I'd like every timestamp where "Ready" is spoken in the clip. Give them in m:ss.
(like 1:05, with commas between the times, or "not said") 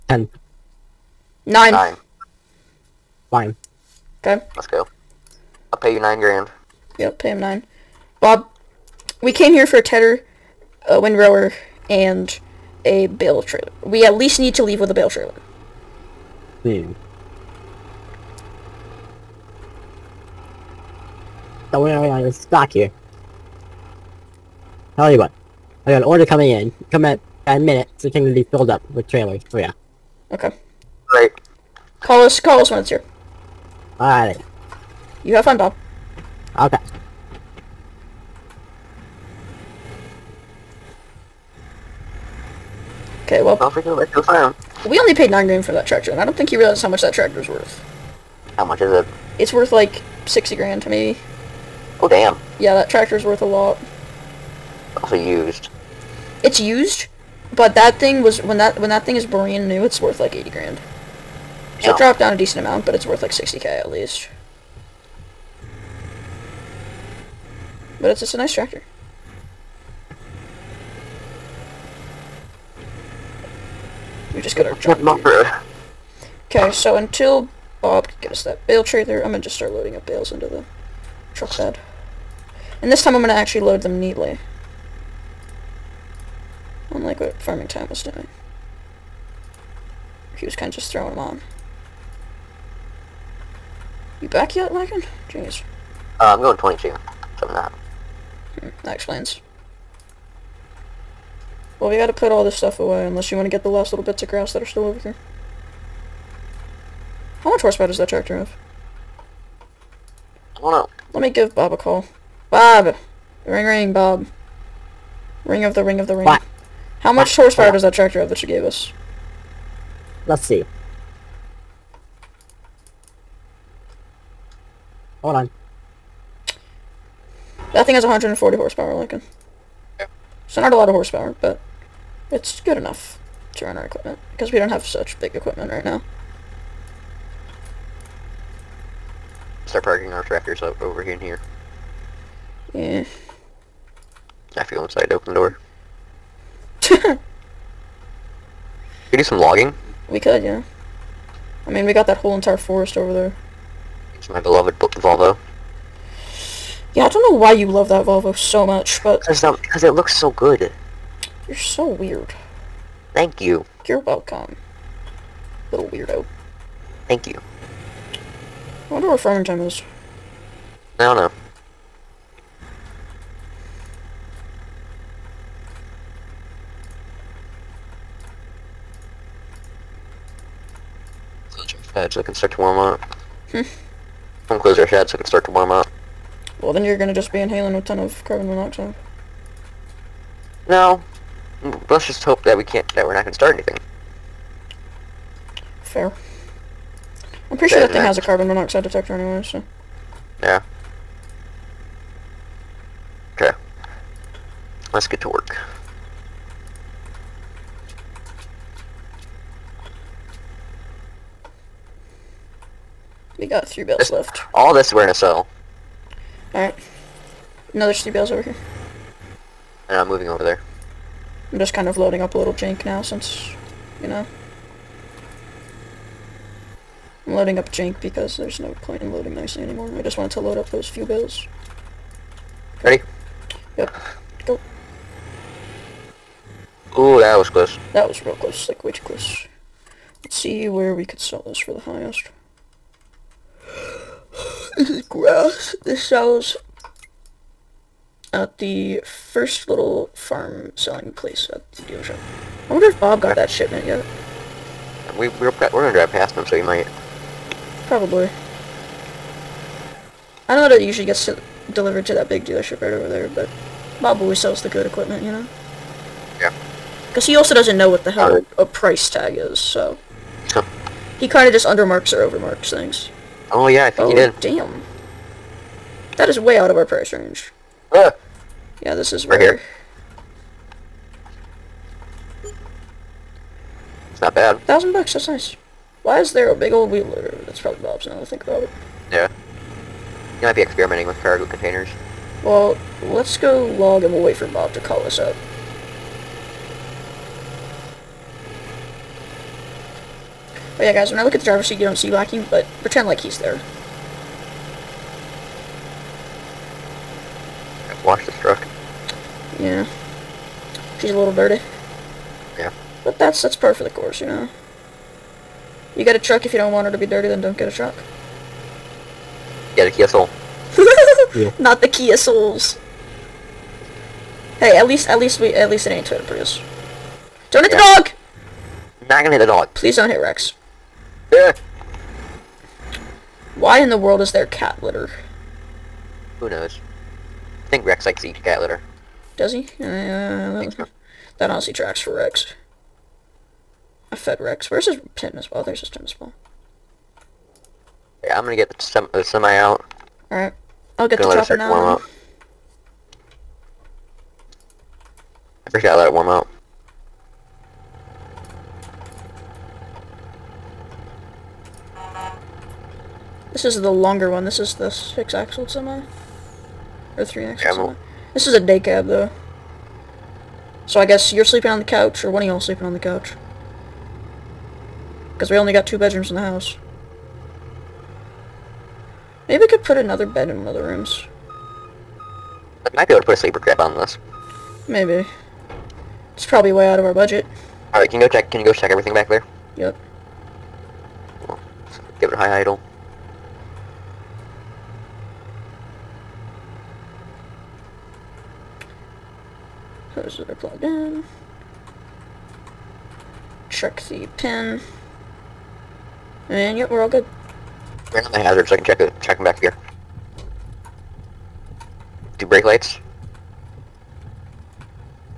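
3:52.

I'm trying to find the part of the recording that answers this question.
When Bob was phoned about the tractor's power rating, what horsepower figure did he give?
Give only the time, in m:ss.
2:08.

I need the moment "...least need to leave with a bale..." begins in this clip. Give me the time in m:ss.
0:14.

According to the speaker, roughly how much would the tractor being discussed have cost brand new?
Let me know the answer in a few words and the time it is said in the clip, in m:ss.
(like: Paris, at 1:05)
80 grand, at 1:00.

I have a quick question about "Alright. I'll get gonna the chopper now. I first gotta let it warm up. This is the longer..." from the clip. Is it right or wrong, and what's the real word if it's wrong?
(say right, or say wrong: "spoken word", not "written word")
right.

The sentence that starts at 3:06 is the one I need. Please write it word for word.
Well, then you're gonna just be inhaling a ton of carbon monoxide.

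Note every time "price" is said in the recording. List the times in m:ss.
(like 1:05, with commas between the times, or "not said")
4:28, 4:36.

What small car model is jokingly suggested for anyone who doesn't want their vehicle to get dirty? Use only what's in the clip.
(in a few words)
Kia Soul.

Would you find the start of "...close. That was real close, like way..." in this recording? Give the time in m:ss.
3:57.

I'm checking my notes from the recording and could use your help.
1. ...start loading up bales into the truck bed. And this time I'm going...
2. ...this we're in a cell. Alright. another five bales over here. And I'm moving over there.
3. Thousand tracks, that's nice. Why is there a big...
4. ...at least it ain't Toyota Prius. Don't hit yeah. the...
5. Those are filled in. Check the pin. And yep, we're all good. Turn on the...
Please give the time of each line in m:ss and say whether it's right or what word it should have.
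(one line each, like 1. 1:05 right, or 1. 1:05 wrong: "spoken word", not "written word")
1. 1:19 right
2. 3:34 wrong: "three", not "five"
3. 4:44 wrong: "bucks", not "tracks"
4. 5:25 right
5. 6:40 wrong: "plugged", not "filled".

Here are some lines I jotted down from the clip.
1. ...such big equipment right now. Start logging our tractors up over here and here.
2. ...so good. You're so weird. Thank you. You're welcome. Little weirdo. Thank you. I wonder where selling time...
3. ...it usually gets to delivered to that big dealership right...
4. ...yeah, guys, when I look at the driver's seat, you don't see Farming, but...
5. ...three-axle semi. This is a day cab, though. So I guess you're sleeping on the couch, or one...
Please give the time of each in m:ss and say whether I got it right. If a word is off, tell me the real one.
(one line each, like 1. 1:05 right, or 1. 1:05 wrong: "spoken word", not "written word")
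1. 2:14 wrong: "parking", not "logging"
2. 2:40 wrong: "farming", not "selling"
3. 4:20 right
4. 5:00 wrong: "Blackie", not "Farming"
5. 6:07 right.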